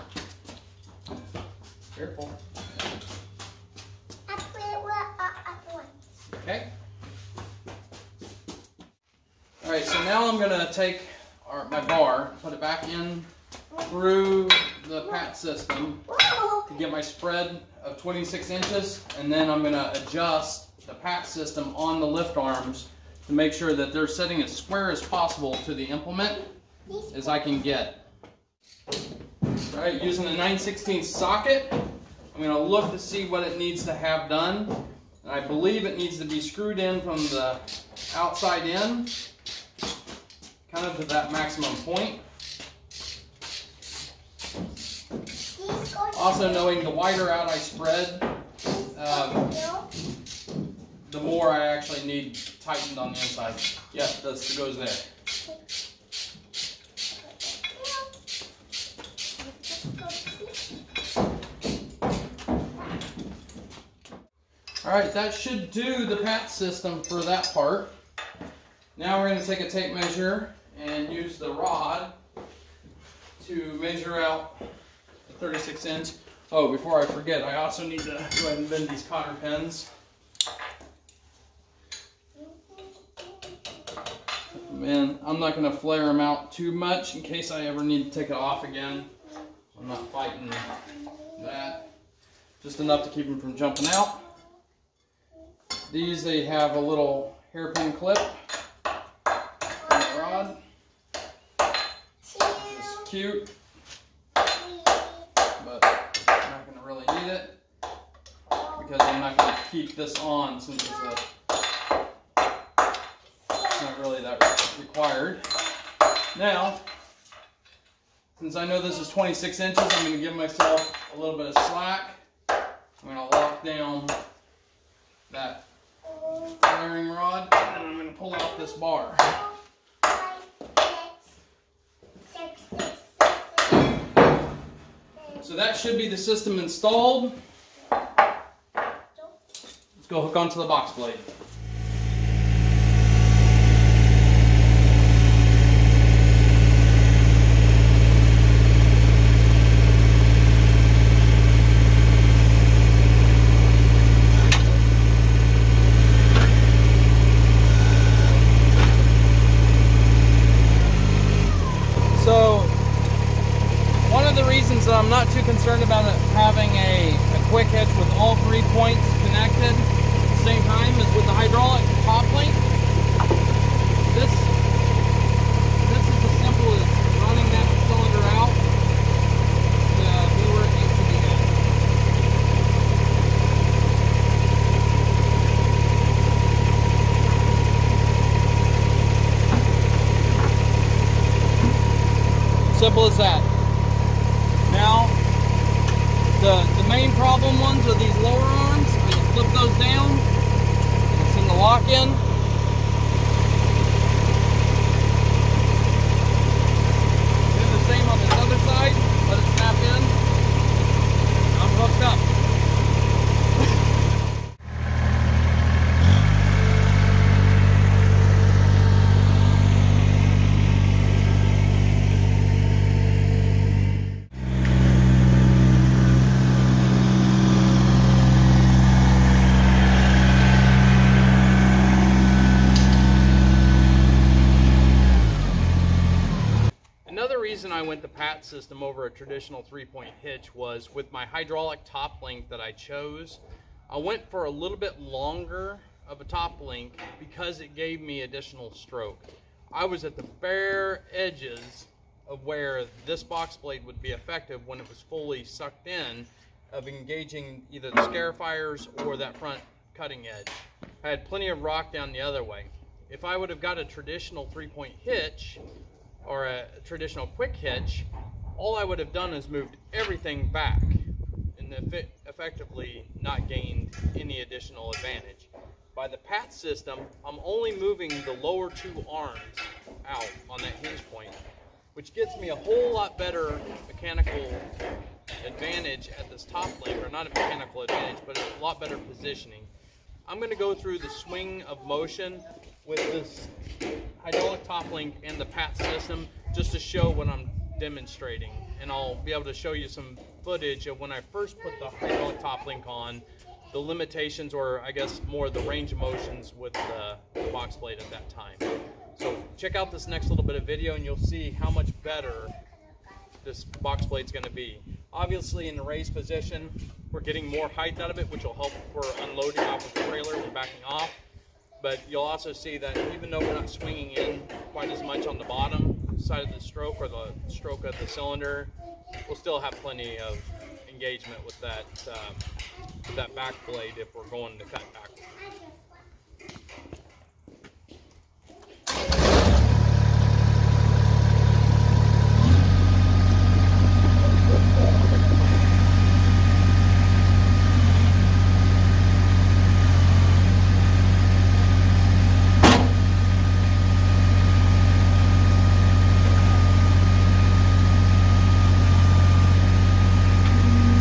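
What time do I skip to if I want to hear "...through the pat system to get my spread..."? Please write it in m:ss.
0:13.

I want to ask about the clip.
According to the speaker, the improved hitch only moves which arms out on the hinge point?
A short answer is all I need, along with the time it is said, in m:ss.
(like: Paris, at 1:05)
lower two arms, at 4:38.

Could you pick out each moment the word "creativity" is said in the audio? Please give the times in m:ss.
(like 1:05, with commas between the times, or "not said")
not said.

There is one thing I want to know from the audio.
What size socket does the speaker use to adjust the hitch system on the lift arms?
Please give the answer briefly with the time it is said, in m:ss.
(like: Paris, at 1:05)
9/16, at 0:30.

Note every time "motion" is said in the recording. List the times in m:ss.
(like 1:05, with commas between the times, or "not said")
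4:51, 5:05.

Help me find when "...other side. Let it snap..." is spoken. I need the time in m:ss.
3:28.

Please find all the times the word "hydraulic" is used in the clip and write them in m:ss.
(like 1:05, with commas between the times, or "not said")
4:01, 4:54, 5:01.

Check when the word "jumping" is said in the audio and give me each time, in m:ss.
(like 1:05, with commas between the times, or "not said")
1:33.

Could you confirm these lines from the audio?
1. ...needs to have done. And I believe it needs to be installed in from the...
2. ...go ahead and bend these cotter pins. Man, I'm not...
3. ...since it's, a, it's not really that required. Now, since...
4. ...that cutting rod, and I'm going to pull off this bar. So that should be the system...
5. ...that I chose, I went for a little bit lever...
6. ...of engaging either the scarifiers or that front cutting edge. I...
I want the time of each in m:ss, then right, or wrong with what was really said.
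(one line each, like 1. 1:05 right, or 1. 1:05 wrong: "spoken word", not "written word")
1. 0:33 wrong: "screwed", not "installed"
2. 1:18 right
3. 1:50 right
4. 2:05 wrong: "firing", not "cutting"
5. 4:02 wrong: "longer", not "lever"
6. 4:16 right.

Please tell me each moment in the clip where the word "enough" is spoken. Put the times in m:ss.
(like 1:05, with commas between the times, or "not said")
1:32.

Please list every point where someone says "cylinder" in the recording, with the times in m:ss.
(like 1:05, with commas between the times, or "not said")
5:28.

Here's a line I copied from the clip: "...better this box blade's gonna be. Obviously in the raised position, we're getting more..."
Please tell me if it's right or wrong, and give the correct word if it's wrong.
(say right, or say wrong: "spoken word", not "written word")
right.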